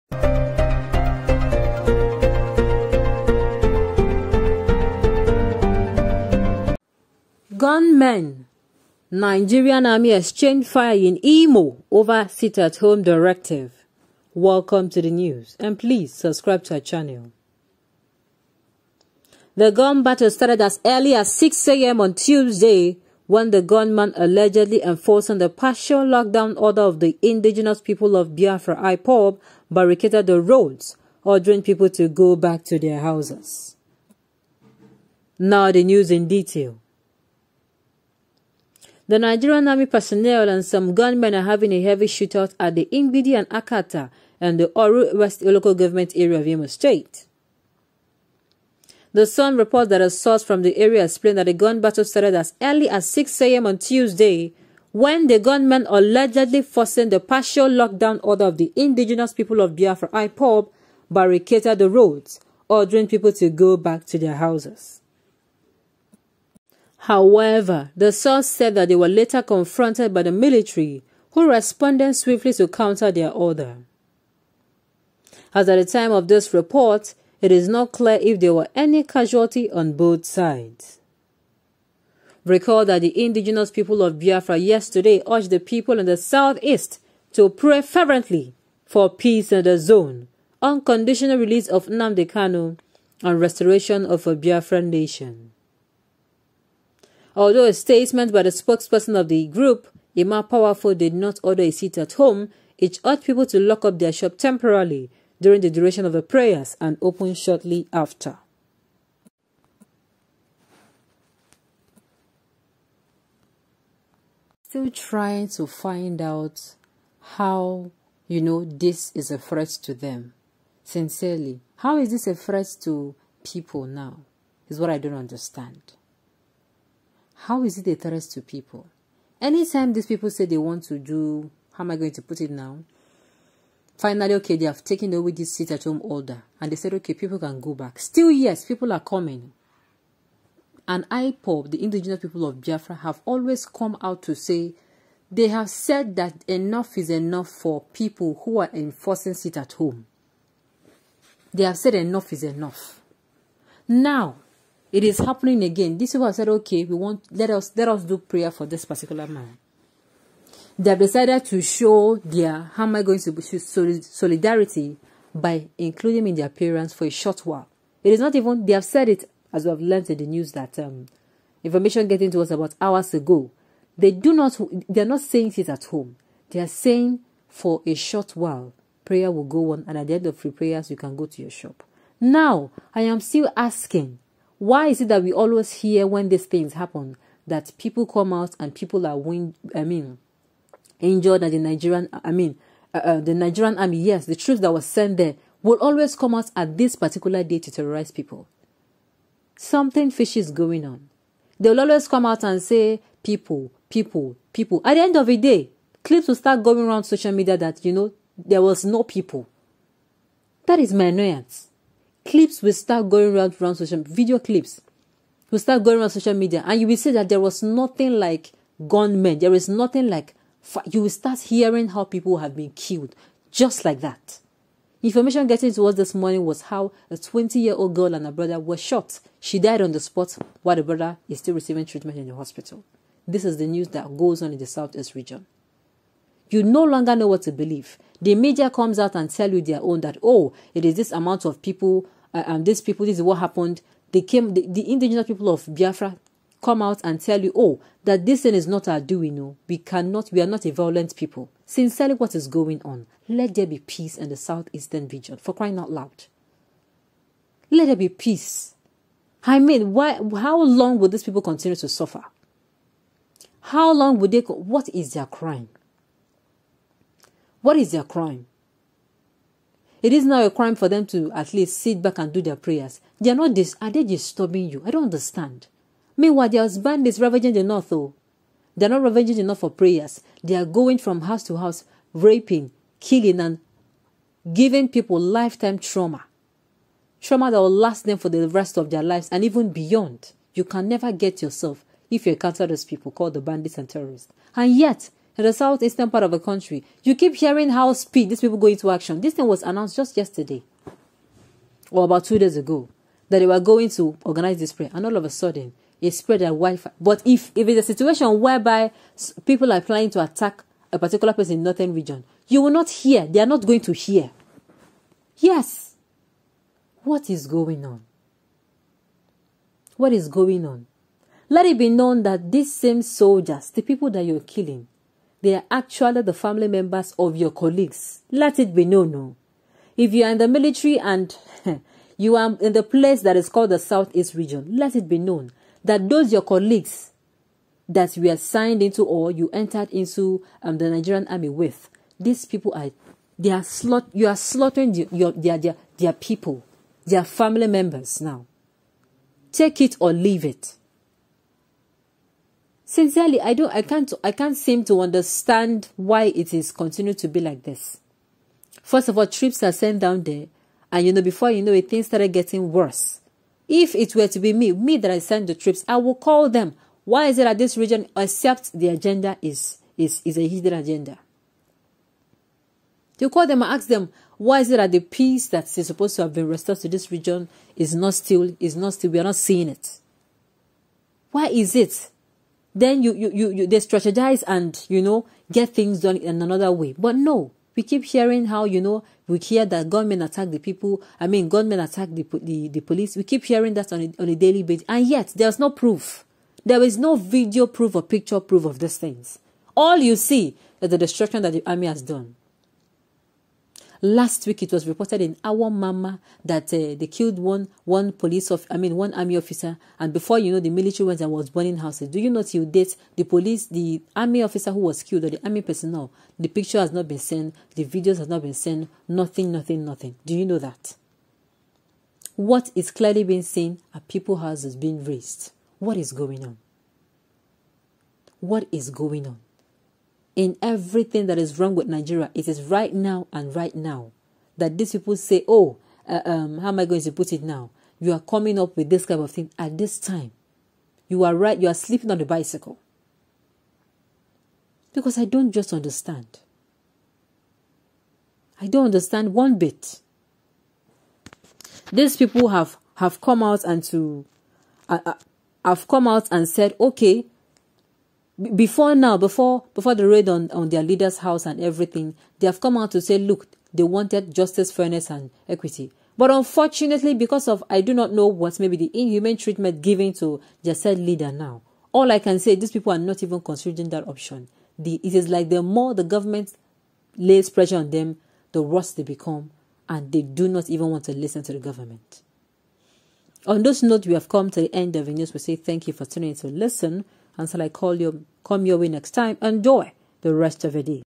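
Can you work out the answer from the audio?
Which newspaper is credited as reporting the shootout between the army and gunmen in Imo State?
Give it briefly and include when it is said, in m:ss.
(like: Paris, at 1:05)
The Sun, at 0:49.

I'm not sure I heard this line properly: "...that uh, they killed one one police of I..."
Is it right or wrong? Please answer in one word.
right.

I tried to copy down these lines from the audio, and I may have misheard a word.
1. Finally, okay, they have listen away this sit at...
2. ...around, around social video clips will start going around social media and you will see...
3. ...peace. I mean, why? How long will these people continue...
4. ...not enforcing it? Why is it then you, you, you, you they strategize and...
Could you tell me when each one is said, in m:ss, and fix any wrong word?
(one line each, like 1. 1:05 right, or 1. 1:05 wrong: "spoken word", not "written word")
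1. 2:13 wrong: "taken", not "listen"
2. 3:33 right
3. 4:18 right
4. 6:19 wrong: "seeing", not "enforcing".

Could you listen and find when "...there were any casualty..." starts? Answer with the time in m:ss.
1:18.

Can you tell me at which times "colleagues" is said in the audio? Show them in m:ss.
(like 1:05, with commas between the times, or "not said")
5:27, 5:36.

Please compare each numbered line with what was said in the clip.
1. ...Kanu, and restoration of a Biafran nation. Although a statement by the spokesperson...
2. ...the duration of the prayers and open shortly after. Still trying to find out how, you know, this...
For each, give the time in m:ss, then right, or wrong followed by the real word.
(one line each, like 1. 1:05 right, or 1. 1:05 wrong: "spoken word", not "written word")
1. 1:32 right
2. 1:45 right.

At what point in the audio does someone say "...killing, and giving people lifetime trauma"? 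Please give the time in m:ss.
4:42.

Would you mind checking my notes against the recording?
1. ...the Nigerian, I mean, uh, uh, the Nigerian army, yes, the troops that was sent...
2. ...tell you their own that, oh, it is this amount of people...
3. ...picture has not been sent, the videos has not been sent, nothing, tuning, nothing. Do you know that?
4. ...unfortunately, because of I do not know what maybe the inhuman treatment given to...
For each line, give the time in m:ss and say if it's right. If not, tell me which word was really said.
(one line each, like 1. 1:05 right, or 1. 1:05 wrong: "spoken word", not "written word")
1. 3:11 right
2. 3:59 right
3. 6:56 wrong: "nothing", not "tuning"
4. 7:46 right.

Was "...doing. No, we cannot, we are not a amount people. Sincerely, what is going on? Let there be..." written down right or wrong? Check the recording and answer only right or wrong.
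wrong.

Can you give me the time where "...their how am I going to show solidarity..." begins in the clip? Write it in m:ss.
2:42.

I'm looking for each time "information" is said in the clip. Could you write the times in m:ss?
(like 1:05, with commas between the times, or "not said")
2:51, 3:45.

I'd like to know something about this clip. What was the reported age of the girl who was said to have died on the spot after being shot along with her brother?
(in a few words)
20.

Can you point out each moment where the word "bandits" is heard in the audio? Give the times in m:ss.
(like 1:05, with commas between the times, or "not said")
4:36, 4:53.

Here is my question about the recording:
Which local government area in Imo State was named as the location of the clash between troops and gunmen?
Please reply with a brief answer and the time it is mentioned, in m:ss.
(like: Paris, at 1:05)
Oru West, at 0:44.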